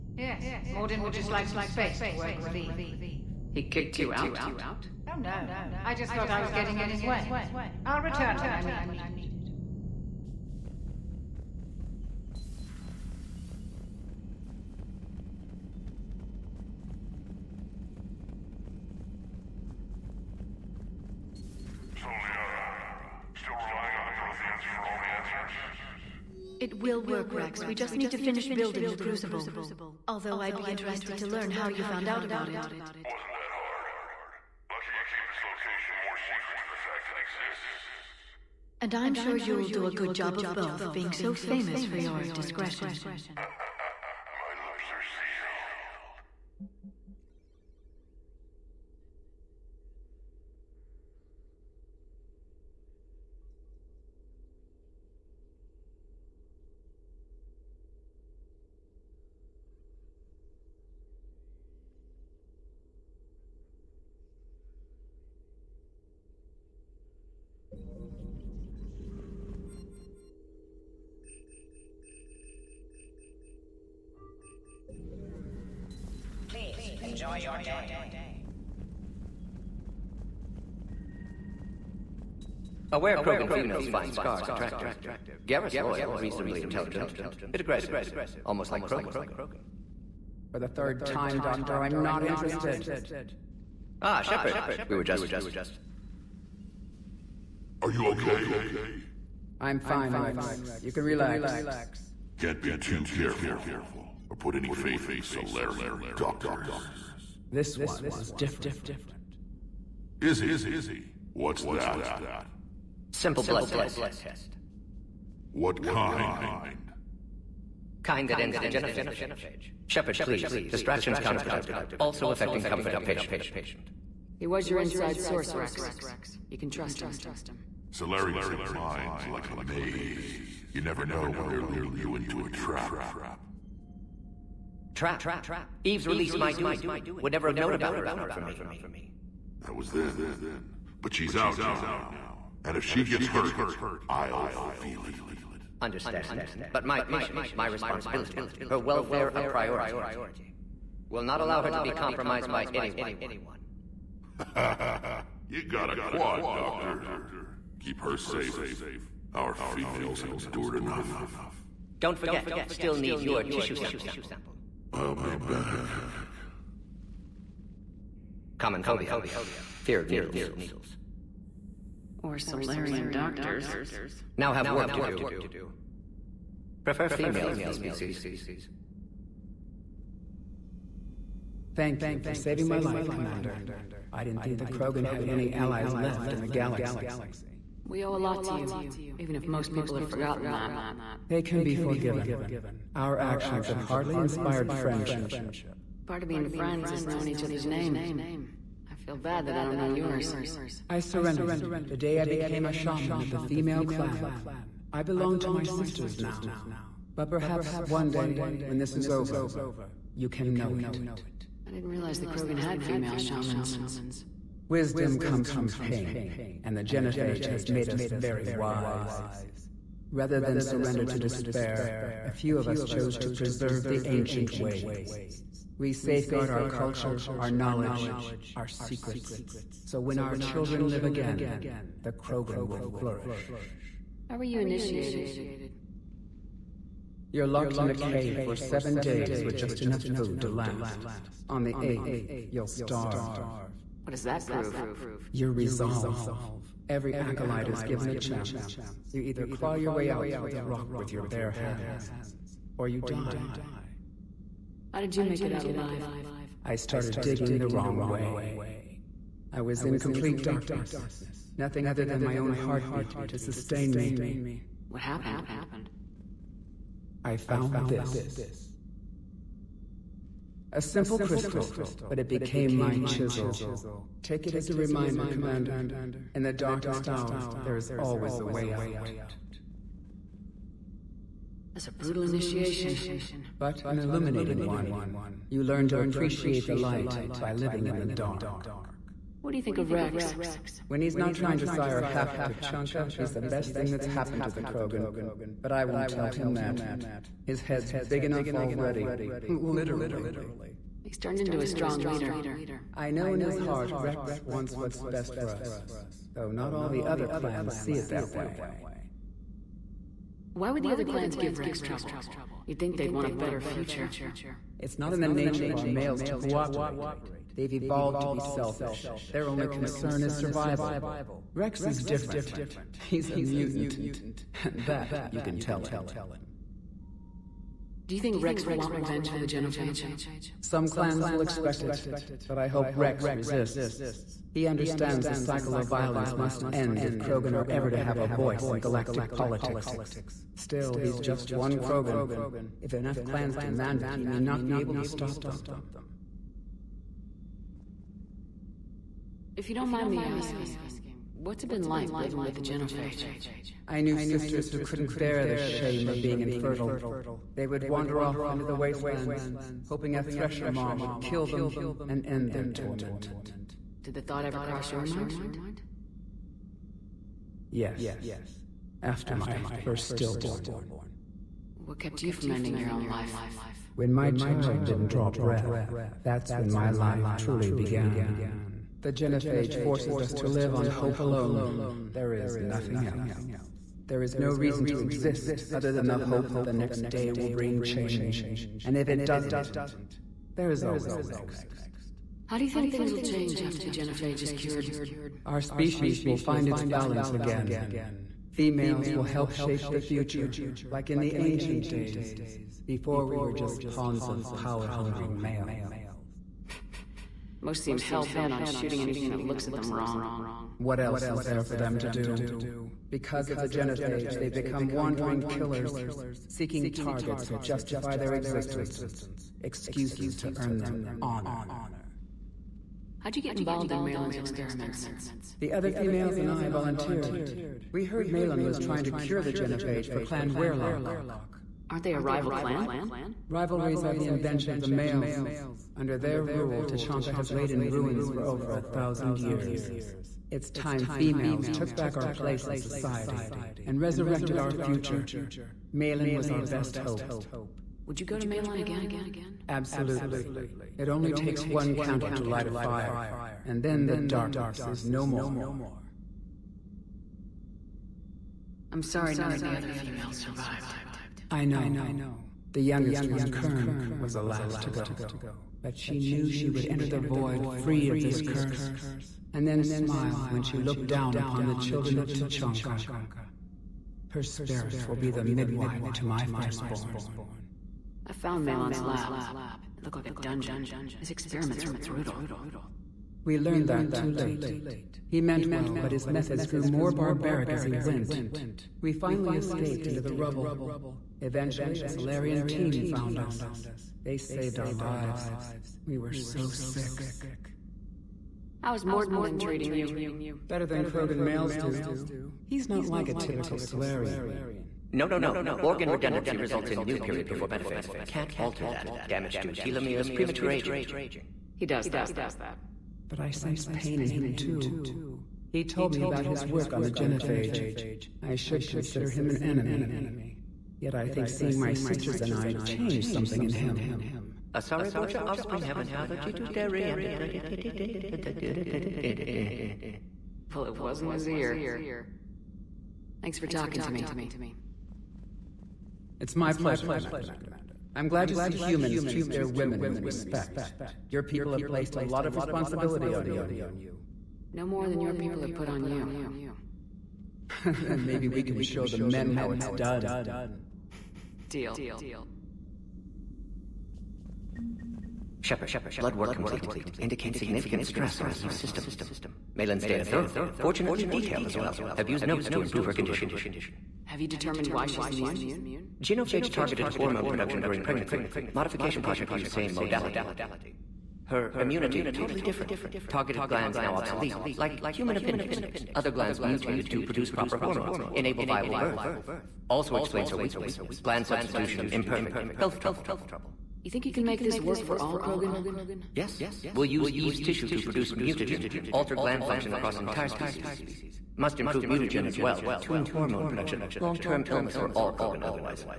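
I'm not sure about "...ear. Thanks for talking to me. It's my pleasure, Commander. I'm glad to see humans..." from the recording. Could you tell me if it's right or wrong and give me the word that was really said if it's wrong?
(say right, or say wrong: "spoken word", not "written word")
right.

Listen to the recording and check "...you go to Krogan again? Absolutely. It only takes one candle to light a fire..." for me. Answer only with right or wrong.
wrong.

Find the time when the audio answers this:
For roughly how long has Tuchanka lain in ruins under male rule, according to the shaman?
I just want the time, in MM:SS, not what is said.
07:18.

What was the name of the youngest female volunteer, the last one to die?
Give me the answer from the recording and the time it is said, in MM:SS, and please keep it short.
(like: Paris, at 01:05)
Kern, at 07:43.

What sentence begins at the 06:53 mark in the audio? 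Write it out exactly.
Because of the genophage, they become wandering killers, seeking targets to justify their existence, excuses to earn them honor.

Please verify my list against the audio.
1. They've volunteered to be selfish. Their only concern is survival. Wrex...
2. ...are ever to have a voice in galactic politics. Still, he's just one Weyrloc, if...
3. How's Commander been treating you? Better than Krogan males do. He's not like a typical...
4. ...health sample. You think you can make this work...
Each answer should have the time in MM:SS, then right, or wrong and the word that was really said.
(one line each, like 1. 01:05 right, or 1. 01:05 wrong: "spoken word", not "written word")
1. 05:17 wrong: "evolved", not "volunteered"
2. 05:37 wrong: "Krogan", not "Weyrloc"
3. 08:18 wrong: "Mordin", not "Commander"
4. 09:42 wrong: "trouble", not "sample".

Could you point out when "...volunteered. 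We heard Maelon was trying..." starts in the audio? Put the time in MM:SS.
07:06.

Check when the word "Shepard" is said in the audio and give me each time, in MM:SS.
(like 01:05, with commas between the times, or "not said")
01:34, 01:59, 09:15.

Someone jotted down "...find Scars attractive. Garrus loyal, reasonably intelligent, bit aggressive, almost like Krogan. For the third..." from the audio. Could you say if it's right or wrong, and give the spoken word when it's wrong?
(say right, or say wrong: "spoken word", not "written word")
right.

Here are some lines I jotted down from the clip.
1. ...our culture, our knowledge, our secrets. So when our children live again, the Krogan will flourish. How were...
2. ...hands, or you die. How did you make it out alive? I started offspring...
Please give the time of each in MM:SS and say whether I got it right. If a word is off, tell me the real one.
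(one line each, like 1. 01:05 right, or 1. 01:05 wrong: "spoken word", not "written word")
1. 03:46 right
2. 04:11 wrong: "digging", not "offspring".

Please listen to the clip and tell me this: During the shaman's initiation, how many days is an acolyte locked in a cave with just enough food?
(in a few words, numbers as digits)
7.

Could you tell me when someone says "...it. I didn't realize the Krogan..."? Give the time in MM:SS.
03:30.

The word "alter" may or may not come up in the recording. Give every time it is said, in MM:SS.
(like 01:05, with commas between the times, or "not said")
08:28, 09:49.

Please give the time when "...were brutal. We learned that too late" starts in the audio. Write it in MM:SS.
08:01.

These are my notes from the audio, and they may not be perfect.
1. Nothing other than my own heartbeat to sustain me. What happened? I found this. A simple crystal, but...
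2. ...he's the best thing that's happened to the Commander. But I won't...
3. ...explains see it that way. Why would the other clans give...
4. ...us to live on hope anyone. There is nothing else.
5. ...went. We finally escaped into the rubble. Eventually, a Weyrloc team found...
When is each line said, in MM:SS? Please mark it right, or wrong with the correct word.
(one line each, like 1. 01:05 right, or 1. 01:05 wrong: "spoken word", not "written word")
1. 04:21 right
2. 04:53 wrong: "Krogan", not "Commander"
3. 05:07 wrong: "clans", not "explains"
4. 06:20 wrong: "alone", not "anyone"
5. 08:07 wrong: "Salarian", not "Weyrloc".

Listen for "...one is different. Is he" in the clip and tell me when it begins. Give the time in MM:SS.
01:47.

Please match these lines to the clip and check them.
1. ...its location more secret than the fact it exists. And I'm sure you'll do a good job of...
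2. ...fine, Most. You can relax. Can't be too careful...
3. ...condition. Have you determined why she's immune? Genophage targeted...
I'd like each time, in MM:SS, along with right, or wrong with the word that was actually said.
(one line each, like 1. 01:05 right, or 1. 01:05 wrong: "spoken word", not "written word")
1. 00:35 right
2. 01:39 wrong: "Wrex", not "Most"
3. 09:23 right.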